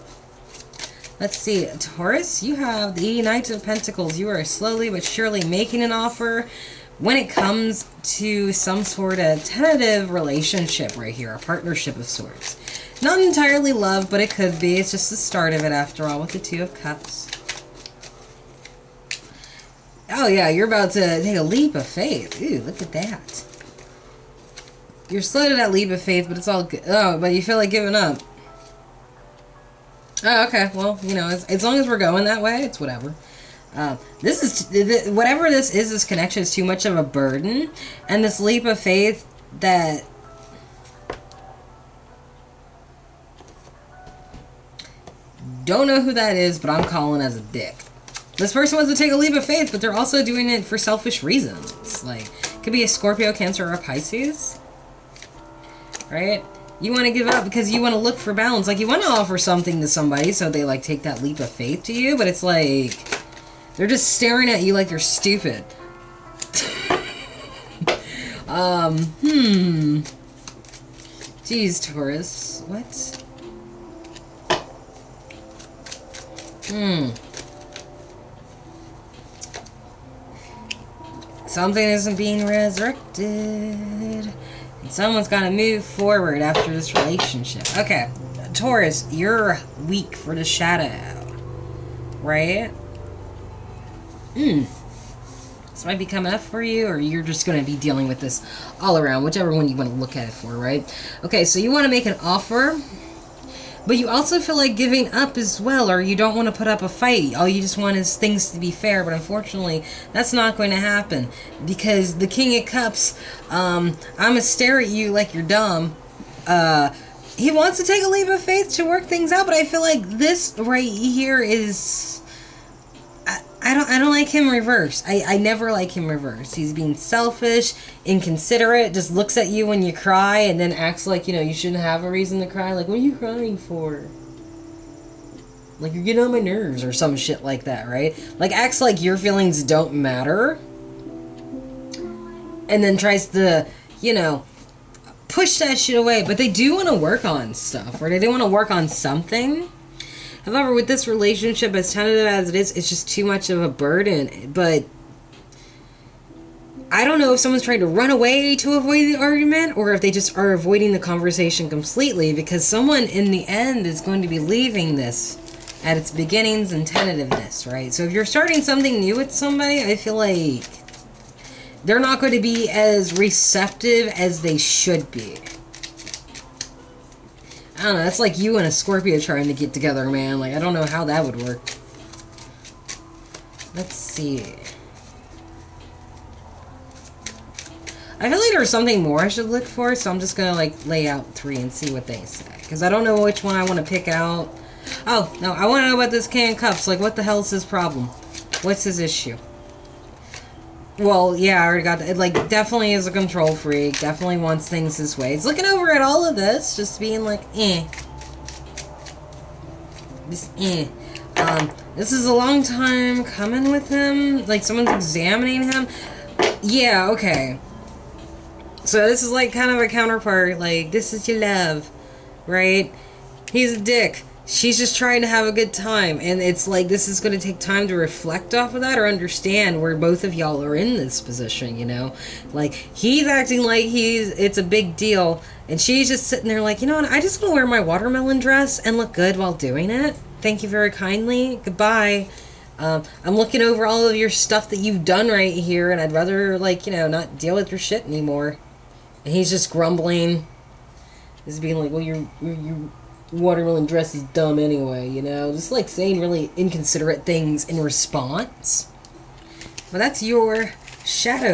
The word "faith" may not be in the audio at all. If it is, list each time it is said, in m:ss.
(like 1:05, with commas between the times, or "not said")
0:21, 0:26, 0:38, 0:49, 1:01, 1:58.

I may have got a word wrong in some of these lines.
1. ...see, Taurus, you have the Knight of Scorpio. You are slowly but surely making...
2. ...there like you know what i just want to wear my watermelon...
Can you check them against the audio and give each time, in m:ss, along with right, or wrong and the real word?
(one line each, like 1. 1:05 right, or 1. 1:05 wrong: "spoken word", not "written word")
1. 0:01 wrong: "Pentacles", not "Scorpio"
2. 3:56 right.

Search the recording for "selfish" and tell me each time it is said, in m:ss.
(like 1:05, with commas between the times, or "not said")
0:50, 2:06.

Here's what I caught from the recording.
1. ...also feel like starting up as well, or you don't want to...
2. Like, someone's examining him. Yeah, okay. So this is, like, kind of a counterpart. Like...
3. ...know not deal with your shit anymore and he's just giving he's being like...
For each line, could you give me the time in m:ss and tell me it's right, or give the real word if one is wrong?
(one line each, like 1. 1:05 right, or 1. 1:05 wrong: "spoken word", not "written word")
1. 1:44 wrong: "giving", not "starting"
2. 3:34 right
3. 4:06 wrong: "grumbling", not "giving".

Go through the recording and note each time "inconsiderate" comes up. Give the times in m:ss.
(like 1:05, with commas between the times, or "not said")
2:08, 4:16.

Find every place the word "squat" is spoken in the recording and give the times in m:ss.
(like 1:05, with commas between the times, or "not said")
not said.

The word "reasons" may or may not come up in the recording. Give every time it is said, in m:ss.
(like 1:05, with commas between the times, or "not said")
0:51, 2:12.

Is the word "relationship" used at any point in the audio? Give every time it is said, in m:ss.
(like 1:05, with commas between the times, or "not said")
0:10, 1:26, 2:31.